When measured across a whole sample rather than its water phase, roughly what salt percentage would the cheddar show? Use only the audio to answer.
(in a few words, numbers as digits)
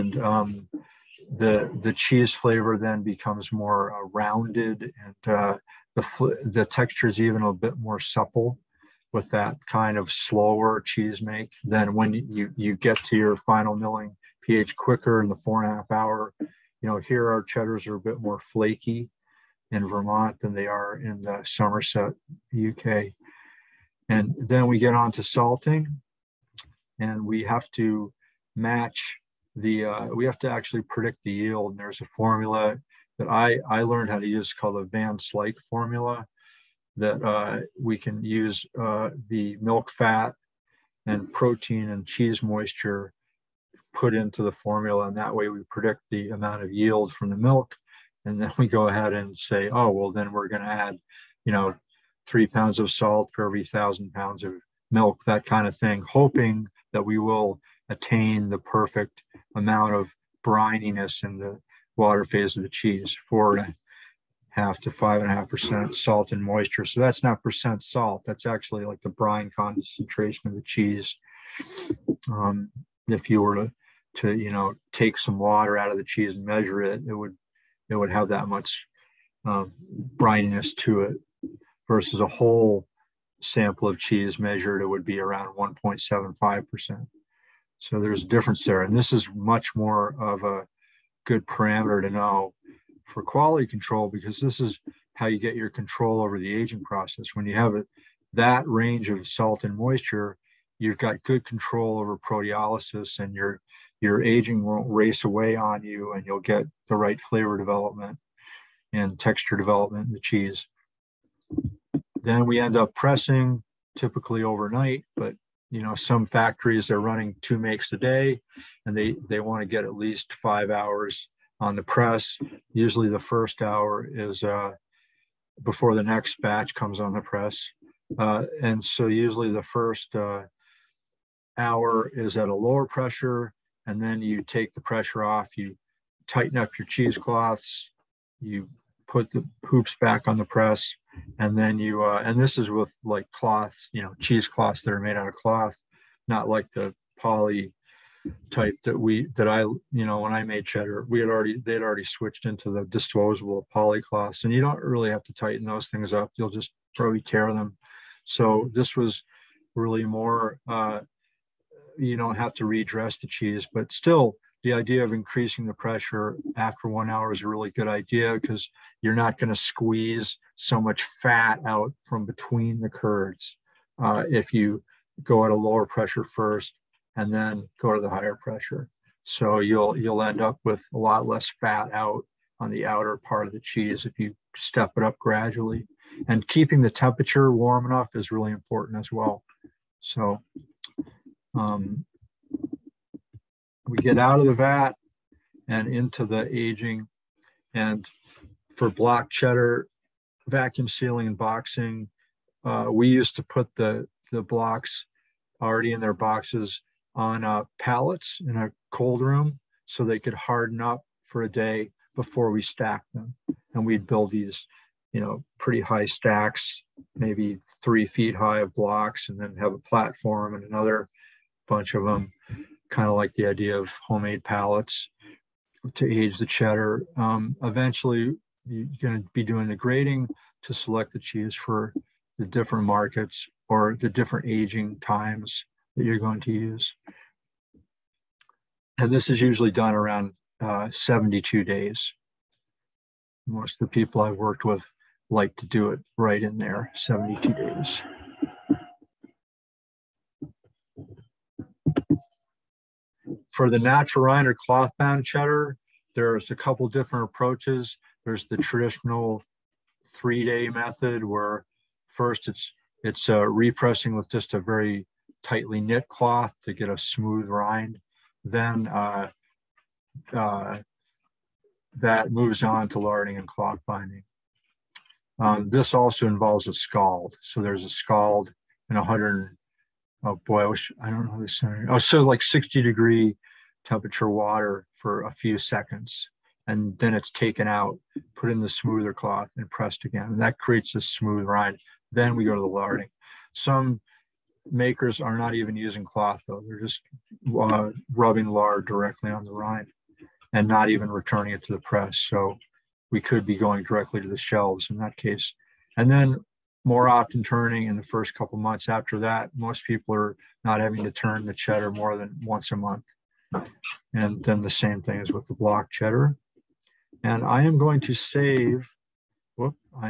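1.75%.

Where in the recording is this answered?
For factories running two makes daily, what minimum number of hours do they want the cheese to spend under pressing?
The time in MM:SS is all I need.
02:00.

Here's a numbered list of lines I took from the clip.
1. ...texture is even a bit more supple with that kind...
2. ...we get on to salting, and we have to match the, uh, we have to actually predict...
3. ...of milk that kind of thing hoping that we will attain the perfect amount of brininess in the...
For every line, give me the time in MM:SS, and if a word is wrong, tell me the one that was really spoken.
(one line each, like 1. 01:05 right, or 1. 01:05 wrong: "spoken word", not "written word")
1. 00:06 right
2. 00:24 right
3. 00:54 right.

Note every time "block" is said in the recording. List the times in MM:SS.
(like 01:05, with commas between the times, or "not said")
03:18, 03:24, 03:38, 05:15.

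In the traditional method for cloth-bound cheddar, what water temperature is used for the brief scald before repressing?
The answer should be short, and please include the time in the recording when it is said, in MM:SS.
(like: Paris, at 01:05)
60 degrees, at 04:42.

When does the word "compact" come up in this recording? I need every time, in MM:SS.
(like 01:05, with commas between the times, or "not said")
not said.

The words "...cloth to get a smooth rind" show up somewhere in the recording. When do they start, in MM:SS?
04:26.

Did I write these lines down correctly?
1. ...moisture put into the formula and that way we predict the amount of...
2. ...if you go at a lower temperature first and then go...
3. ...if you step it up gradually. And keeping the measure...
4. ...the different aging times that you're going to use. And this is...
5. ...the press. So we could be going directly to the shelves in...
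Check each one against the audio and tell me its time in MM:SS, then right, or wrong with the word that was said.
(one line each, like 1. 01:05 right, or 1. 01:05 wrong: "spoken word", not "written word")
1. 00:42 right
2. 02:54 wrong: "pressure", not "temperature"
3. 03:04 wrong: "temperature", not "measure"
4. 03:54 right
5. 05:01 right.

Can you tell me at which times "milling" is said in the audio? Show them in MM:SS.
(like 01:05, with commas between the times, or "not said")
00:13.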